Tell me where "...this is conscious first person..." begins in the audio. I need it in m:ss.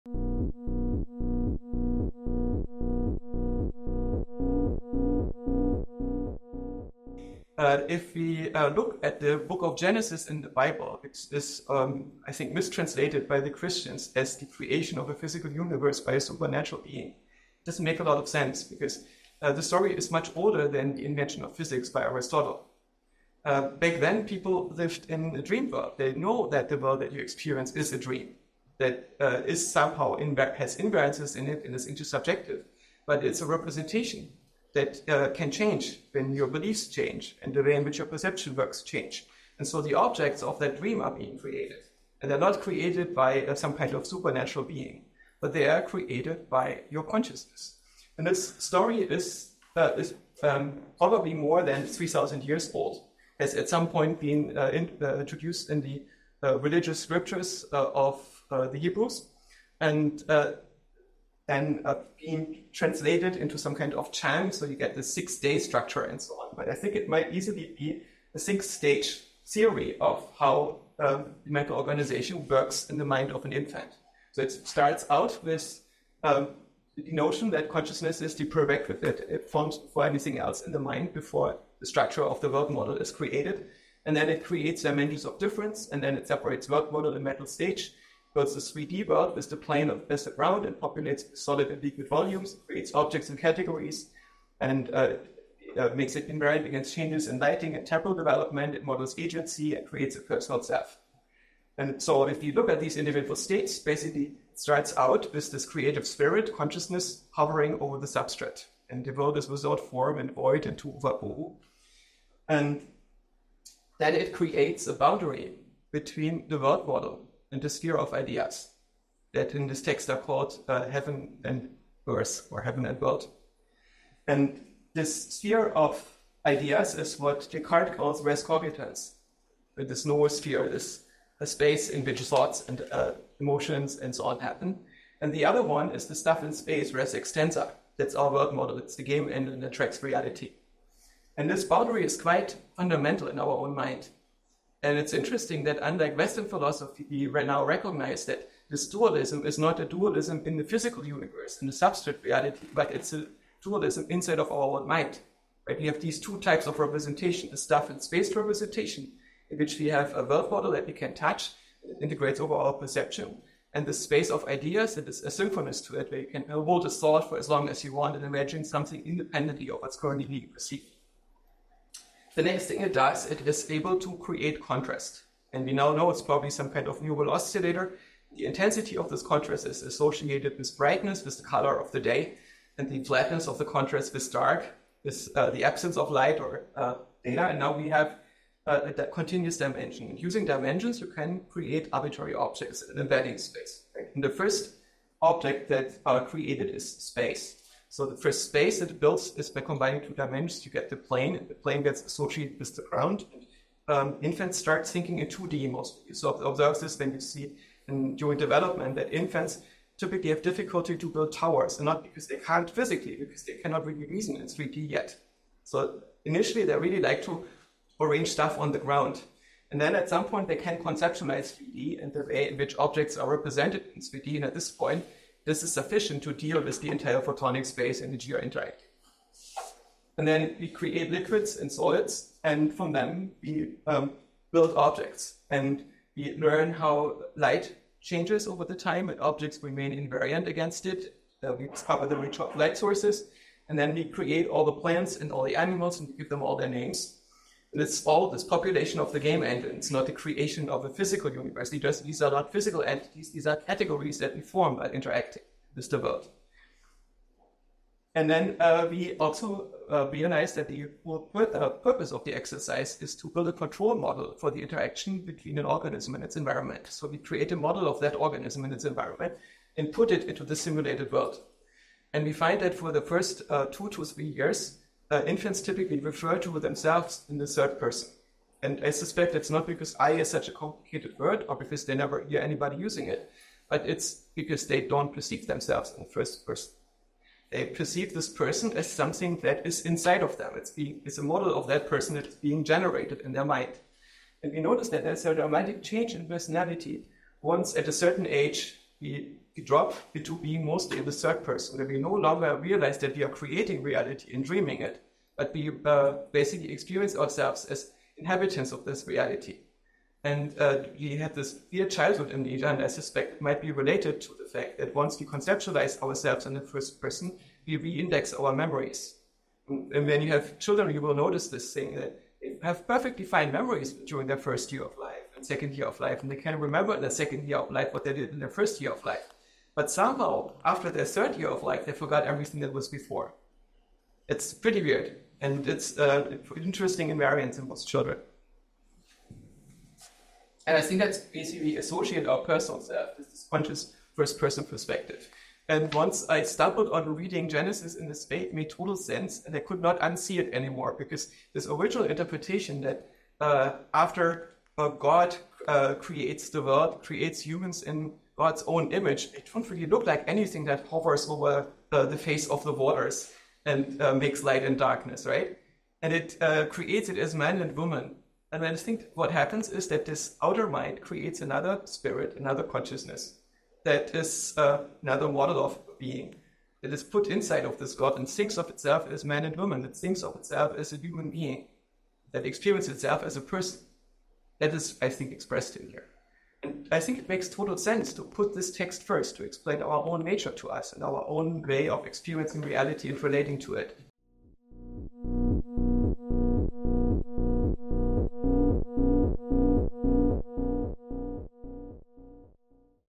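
5:43.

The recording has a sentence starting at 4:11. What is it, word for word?
Just, these are not physical entities, these are categories that we form by interacting with the world.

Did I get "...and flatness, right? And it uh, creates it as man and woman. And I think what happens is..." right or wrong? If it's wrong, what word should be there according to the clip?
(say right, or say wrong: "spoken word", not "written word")
wrong: "darkness", not "flatness".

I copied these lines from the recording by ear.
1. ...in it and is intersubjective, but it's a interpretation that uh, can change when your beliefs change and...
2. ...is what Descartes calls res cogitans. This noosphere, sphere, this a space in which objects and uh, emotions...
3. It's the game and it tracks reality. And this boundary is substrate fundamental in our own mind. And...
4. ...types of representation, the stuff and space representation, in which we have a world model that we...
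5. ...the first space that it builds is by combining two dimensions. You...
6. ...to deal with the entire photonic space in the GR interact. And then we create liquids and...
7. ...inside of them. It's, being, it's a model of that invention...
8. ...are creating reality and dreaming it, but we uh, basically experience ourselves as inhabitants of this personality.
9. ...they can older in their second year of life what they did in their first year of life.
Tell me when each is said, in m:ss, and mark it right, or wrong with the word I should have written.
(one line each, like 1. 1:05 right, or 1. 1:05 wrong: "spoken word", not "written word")
1. 0:31 wrong: "representation", not "interpretation"
2. 2:06 wrong: "thoughts", not "objects"
3. 2:18 wrong: "quite", not "substrate"
4. 2:36 right
5. 3:18 right
6. 3:46 right
7. 4:49 wrong: "person", not "invention"
8. 5:03 wrong: "reality", not "personality"
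9. 5:26 wrong: "remember", not "older".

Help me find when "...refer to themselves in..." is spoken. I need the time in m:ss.
4:35.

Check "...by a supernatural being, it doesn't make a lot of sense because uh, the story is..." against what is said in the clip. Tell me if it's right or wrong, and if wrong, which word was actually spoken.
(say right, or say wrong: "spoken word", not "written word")
right.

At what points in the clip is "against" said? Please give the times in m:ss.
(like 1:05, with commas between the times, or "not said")
1:36, 4:00.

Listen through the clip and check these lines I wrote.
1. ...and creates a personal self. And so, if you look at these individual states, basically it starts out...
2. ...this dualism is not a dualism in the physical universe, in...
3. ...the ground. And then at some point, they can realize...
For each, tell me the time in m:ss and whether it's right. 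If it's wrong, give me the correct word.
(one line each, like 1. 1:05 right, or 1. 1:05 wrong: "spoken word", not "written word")
1. 1:39 right
2. 2:28 right
3. 3:38 wrong: "conceptualize", not "realize".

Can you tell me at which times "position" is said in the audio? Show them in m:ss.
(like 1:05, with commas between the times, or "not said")
not said.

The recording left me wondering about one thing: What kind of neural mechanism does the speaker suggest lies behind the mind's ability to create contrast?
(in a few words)
Neural oscillator.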